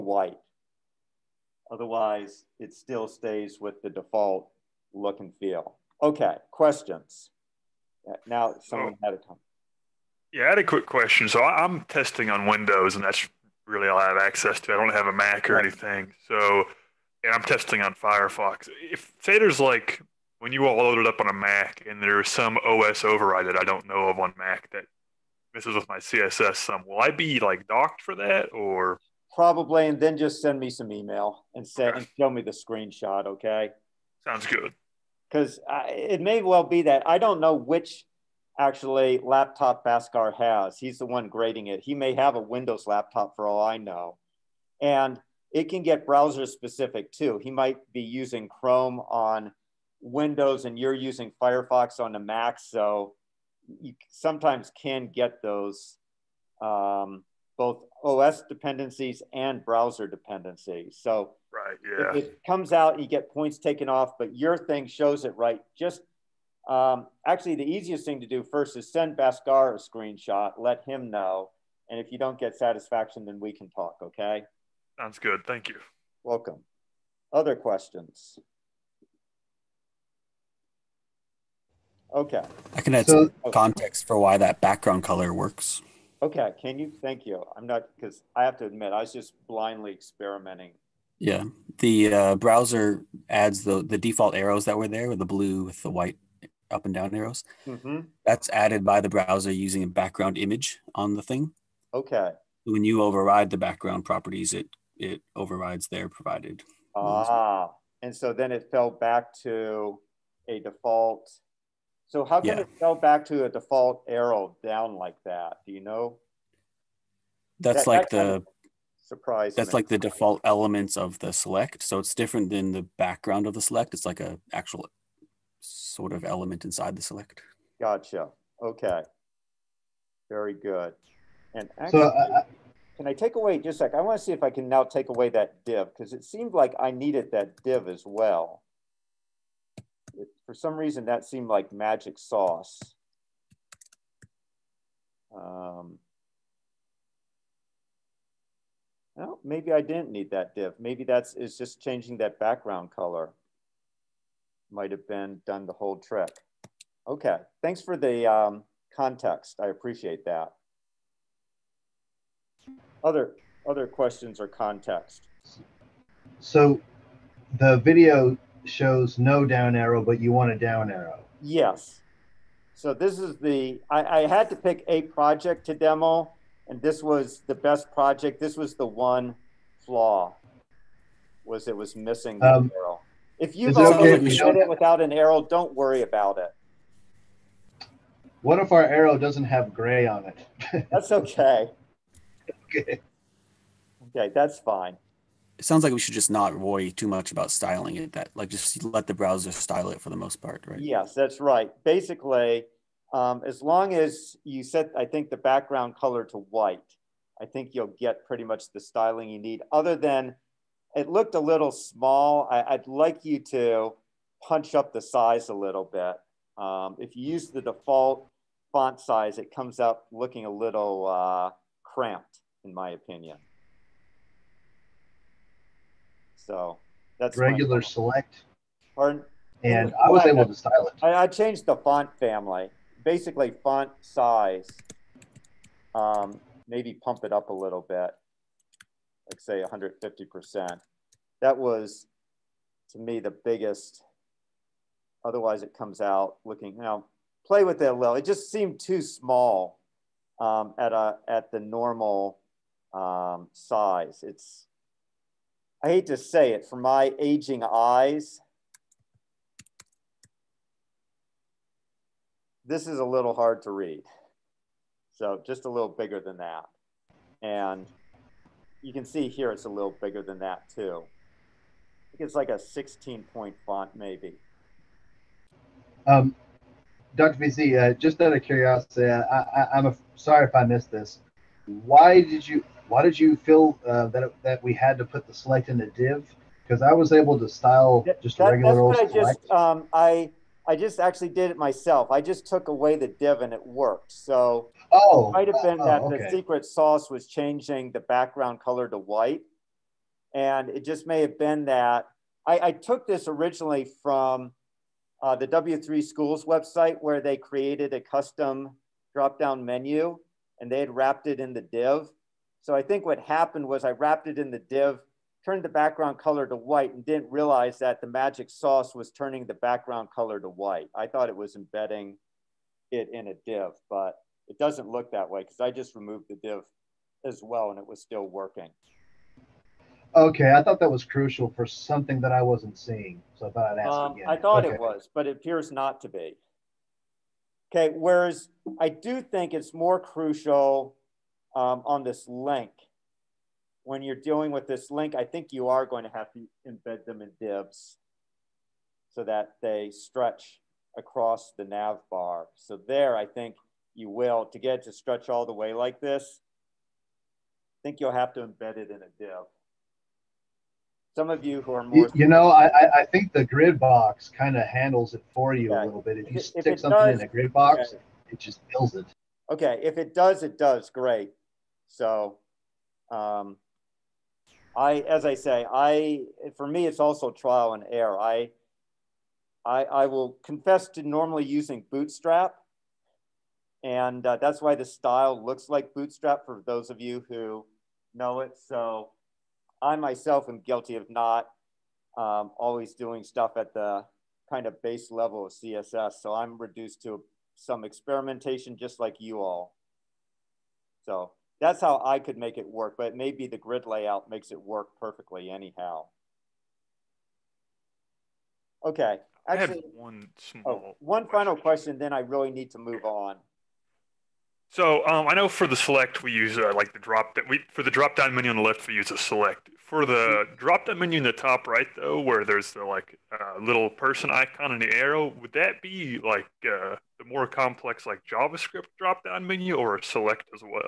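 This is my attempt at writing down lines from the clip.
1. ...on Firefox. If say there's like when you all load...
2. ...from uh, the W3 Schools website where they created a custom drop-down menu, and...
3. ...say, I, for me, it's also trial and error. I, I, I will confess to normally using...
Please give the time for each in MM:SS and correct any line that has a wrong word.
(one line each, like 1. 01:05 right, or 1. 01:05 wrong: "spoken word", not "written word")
1. 00:17 right
2. 05:04 right
3. 06:15 right.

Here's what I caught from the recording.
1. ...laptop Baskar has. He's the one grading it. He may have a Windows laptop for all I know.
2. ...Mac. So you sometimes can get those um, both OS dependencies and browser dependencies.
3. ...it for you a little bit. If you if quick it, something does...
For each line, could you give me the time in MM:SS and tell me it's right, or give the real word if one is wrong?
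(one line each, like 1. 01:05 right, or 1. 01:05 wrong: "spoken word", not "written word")
1. 00:39 right
2. 00:52 right
3. 06:05 wrong: "stick", not "quick".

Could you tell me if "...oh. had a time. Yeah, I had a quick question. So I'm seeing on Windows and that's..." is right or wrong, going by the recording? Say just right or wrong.
wrong.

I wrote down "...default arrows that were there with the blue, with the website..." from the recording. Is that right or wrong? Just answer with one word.
wrong.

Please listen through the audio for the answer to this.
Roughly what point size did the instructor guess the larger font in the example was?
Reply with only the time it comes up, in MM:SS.
04:32.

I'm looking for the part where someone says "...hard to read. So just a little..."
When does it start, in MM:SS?
04:23.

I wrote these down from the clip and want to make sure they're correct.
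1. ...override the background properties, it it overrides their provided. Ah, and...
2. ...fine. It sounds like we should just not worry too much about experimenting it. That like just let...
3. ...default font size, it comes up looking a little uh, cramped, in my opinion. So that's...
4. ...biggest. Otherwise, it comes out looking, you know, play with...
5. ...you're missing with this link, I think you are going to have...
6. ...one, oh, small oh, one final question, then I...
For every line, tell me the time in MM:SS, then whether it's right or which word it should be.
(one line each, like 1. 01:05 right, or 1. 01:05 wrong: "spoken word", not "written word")
1. 01:43 right
2. 03:14 wrong: "styling", not "experimenting"
3. 03:37 right
4. 04:03 right
5. 05:44 wrong: "dealing", not "missing"
6. 06:49 right.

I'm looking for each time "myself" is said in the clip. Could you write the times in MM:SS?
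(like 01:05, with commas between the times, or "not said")
04:51, 06:29.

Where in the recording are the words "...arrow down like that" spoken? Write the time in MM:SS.
01:54.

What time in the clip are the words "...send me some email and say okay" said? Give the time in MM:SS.
00:30.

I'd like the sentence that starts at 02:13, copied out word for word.
I want to see if I can now take away that div because it seemed like I needed that div as well.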